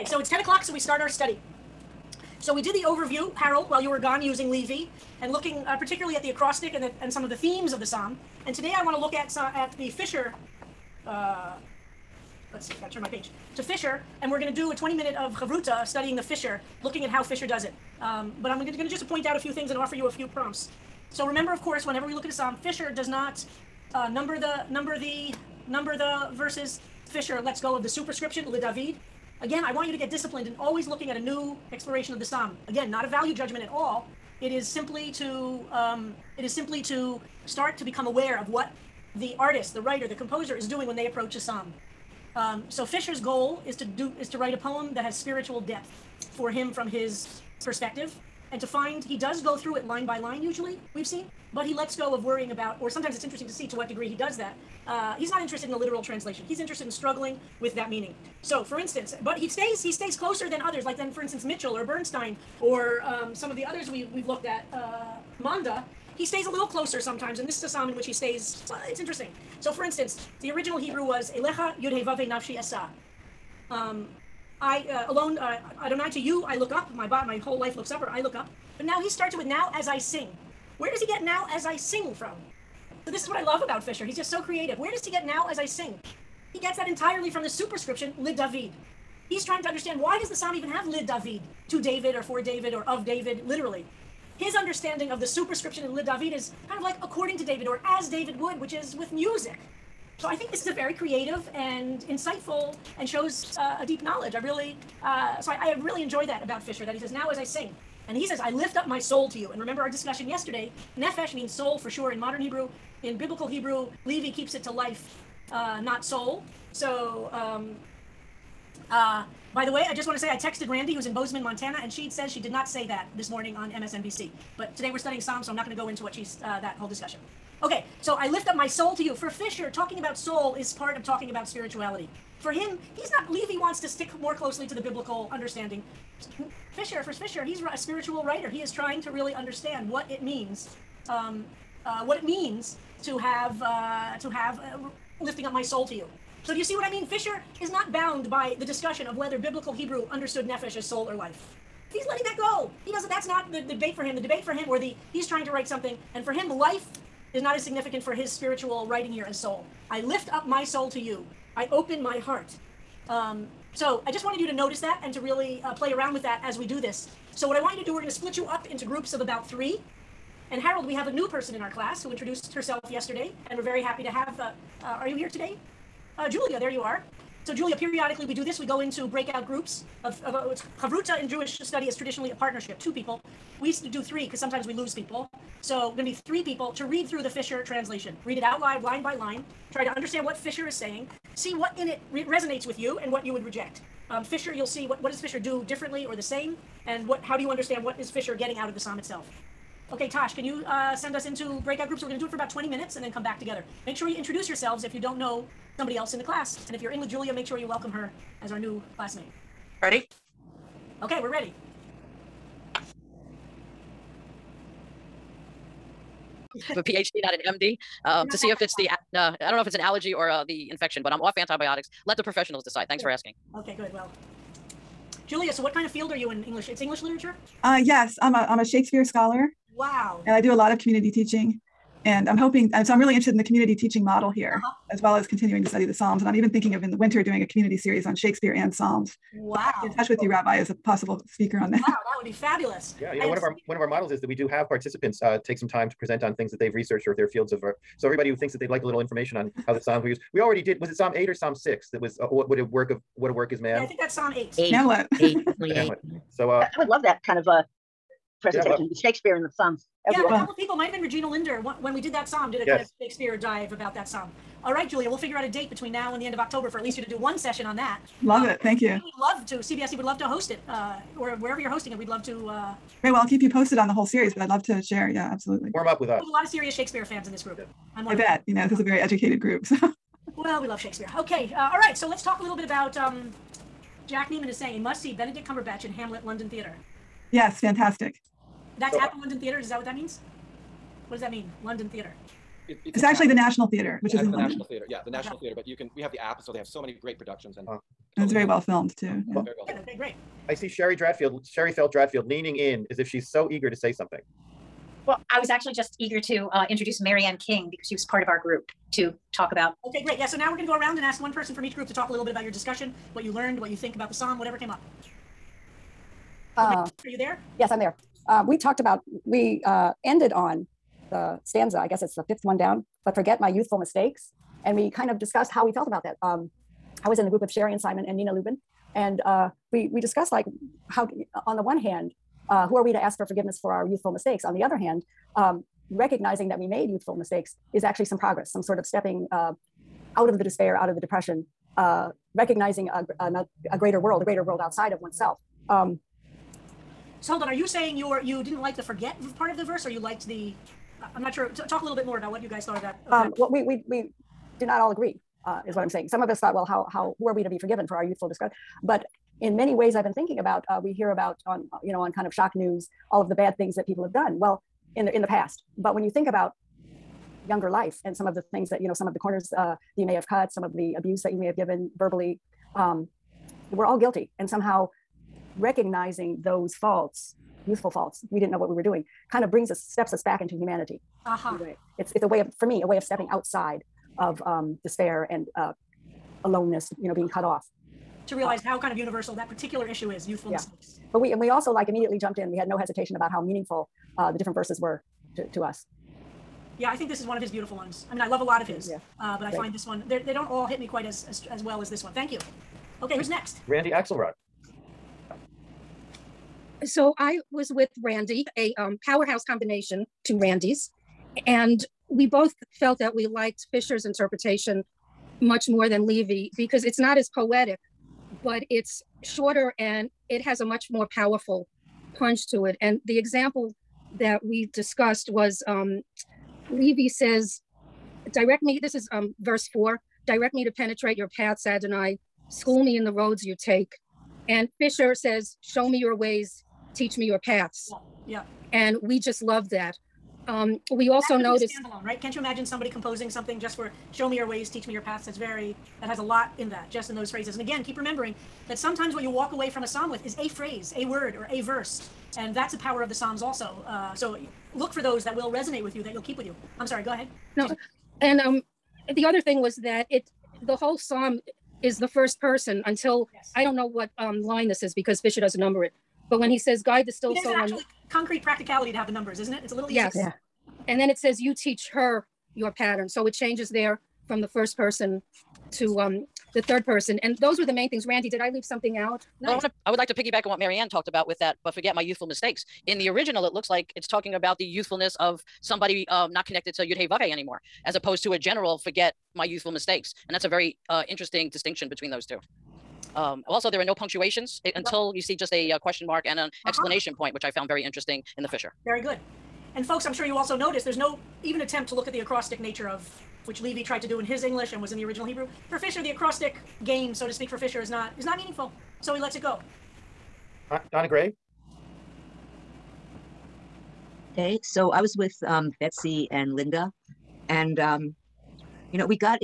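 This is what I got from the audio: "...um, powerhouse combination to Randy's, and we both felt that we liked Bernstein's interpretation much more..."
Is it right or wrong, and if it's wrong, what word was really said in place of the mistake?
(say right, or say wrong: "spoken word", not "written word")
wrong: "Fischer", not "Bernstein".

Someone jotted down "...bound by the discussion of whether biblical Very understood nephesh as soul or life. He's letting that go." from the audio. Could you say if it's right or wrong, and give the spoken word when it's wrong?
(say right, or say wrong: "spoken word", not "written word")
wrong: "Hebrew", not "Very".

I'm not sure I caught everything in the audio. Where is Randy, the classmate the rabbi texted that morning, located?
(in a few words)
Bozeman, Montana.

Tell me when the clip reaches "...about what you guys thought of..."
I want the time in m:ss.
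5:52.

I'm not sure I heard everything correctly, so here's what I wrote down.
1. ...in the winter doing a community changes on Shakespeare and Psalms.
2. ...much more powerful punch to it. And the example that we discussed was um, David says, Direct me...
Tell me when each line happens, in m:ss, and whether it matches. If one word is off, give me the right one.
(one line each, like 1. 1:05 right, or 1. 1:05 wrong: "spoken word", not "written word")
1. 3:56 wrong: "series", not "changes"
2. 7:00 wrong: "Levy", not "David".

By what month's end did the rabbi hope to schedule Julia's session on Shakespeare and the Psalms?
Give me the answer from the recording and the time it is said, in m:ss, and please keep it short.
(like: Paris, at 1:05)
October, at 4:26.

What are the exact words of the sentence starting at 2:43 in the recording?
Um, so I just wanted you to notice that and to really uh, play around with that as we do this.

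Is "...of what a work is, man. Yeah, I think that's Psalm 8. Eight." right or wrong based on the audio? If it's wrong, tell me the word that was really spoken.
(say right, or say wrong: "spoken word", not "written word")
right.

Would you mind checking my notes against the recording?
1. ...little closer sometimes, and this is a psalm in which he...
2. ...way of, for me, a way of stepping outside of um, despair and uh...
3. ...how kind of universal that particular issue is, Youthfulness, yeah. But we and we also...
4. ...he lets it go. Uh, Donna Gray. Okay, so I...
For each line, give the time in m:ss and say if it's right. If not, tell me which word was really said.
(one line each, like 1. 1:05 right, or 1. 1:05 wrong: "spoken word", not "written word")
1. 1:06 right
2. 6:22 right
3. 6:28 right
4. 8:29 right.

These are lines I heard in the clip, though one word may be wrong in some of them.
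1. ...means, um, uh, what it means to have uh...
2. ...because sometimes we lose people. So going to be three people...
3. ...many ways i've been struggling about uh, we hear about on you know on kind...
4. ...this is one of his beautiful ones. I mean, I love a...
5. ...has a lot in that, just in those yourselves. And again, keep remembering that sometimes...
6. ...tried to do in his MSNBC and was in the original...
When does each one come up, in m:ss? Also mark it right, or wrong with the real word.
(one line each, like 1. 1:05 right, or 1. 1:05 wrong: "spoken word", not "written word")
1. 2:20 right
2. 3:04 right
3. 5:59 wrong: "thinking", not "struggling"
4. 6:37 right
5. 7:26 wrong: "phrases", not "yourselves"
6. 8:23 wrong: "English", not "MSNBC".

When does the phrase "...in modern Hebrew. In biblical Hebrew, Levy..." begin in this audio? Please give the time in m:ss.
1:52.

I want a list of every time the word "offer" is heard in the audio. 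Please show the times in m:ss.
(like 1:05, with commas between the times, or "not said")
0:19.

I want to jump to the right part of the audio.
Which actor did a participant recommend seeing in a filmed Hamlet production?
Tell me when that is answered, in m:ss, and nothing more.
4:45.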